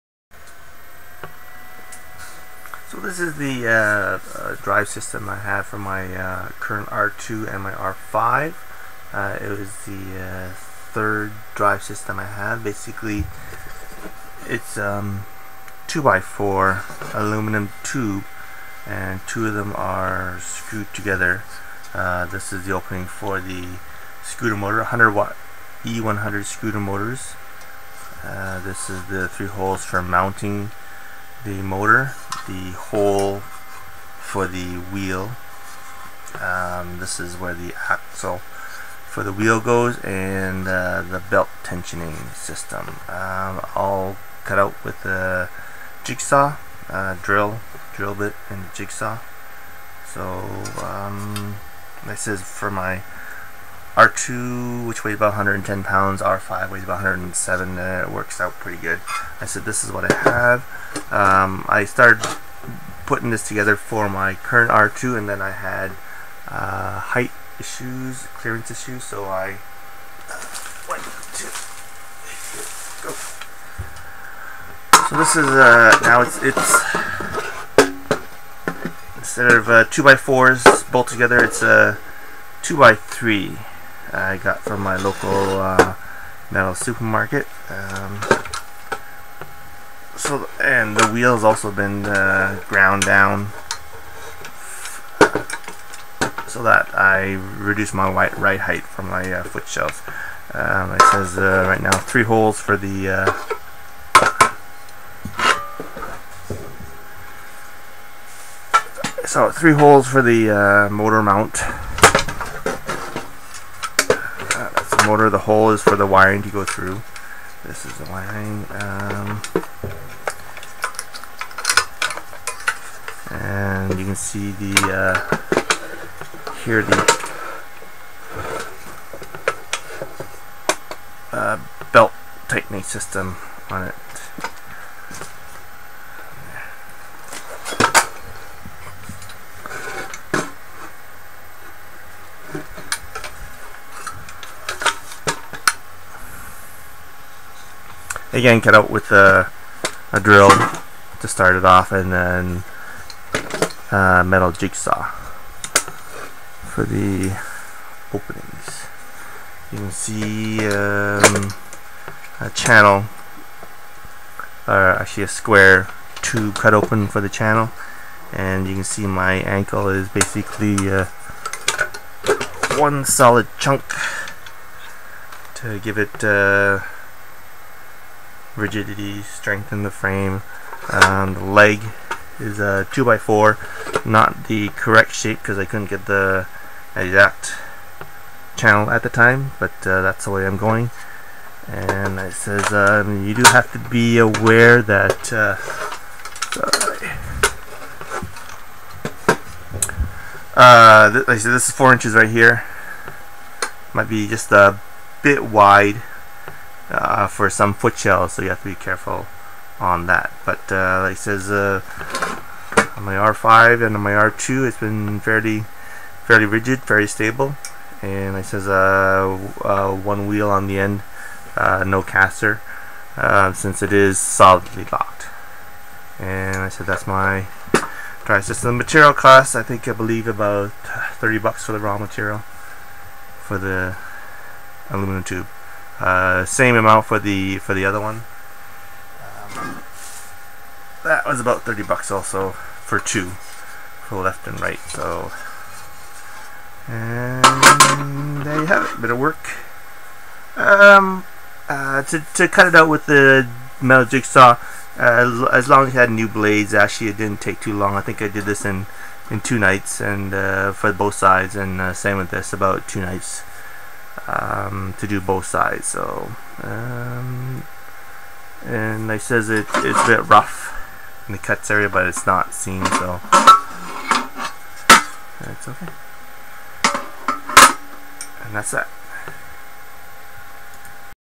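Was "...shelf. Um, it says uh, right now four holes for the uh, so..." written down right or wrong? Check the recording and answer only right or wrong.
wrong.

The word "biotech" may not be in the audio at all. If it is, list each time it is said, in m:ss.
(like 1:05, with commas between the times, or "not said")
not said.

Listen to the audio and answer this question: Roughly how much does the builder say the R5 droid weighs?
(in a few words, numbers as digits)
107 pounds.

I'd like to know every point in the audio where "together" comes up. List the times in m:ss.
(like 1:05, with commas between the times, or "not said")
0:20, 1:03, 1:21.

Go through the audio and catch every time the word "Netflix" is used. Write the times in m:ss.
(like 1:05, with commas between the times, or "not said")
not said.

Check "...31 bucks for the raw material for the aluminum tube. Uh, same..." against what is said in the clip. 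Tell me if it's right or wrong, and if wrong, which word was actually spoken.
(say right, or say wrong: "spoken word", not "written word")
wrong: "30", not "31".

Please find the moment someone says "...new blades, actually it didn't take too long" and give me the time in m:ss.
4:16.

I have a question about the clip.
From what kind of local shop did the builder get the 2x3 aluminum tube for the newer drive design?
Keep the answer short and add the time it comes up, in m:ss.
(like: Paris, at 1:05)
metal supermarket, at 1:26.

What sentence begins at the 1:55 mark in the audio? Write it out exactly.
The hole is for the wiring to go through.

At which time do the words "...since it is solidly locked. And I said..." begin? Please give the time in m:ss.
3:43.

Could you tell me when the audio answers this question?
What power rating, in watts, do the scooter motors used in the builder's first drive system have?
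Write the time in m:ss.
0:24.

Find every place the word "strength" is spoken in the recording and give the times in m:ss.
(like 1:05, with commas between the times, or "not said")
2:59.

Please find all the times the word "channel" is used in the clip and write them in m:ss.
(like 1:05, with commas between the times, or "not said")
2:42, 2:47, 3:08.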